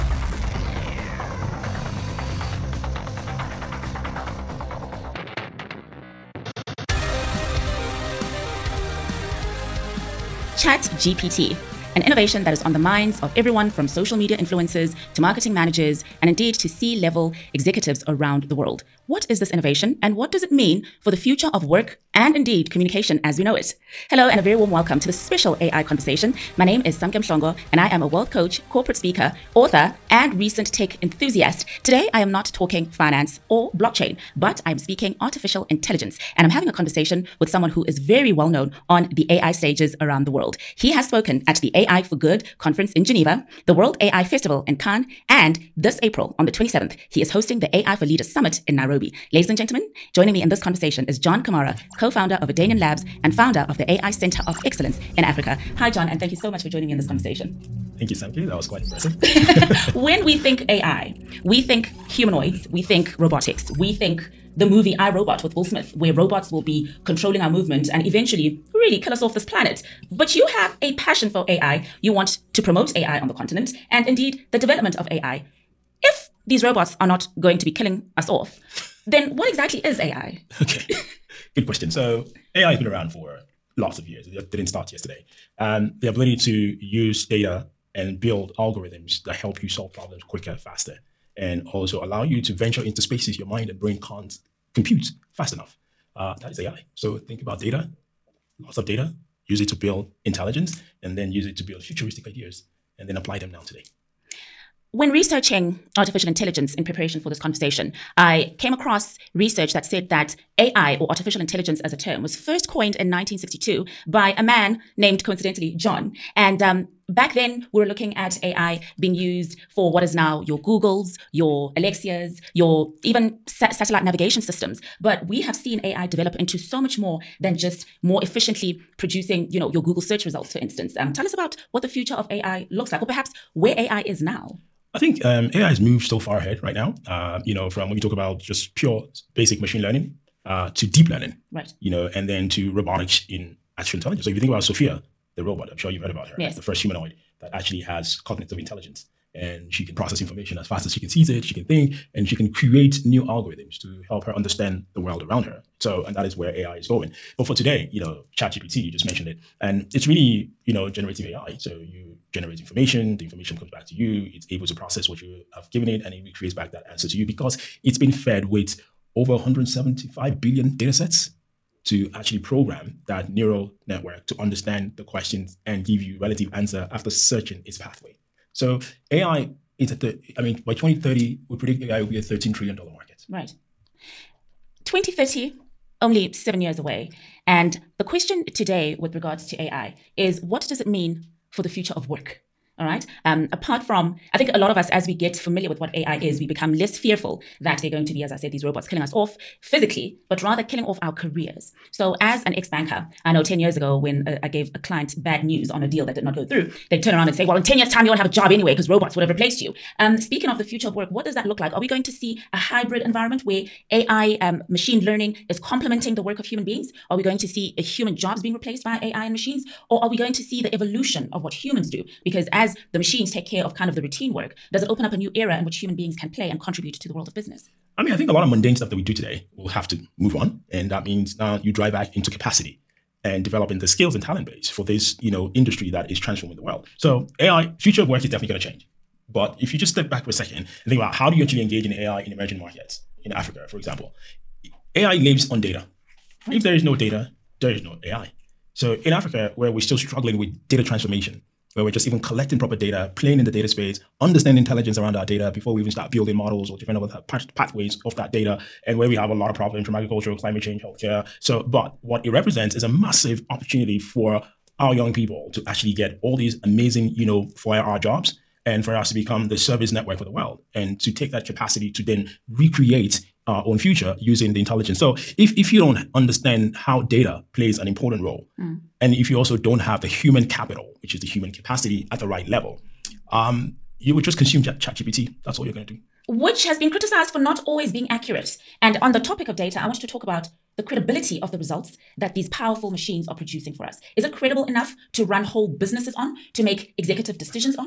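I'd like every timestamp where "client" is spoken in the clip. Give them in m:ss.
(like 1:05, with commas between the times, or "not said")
3:24.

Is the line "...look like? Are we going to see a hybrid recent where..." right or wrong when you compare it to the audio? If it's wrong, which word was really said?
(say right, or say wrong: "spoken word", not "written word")
wrong: "environment", not "recent".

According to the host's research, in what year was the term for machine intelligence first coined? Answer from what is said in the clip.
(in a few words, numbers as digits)
1962.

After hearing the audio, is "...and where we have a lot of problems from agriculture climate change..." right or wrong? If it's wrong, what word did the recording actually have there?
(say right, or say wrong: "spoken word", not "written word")
right.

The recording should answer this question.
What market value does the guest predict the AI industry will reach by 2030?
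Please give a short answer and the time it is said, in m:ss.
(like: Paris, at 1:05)
13 trillion dollars, at 3:02.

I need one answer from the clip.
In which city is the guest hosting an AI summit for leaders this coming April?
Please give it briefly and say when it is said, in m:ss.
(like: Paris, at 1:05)
Nairobi, at 0:48.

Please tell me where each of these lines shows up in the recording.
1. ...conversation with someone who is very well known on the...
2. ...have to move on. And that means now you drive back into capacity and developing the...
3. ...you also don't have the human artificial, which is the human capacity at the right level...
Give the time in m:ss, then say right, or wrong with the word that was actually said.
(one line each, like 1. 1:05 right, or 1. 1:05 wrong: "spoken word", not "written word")
1. 0:36 right
2. 3:49 right
3. 4:39 wrong: "capital", not "artificial".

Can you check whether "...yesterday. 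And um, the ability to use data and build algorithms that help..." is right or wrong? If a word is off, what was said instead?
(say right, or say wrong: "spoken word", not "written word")
right.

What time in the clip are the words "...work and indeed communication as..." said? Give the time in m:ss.
0:21.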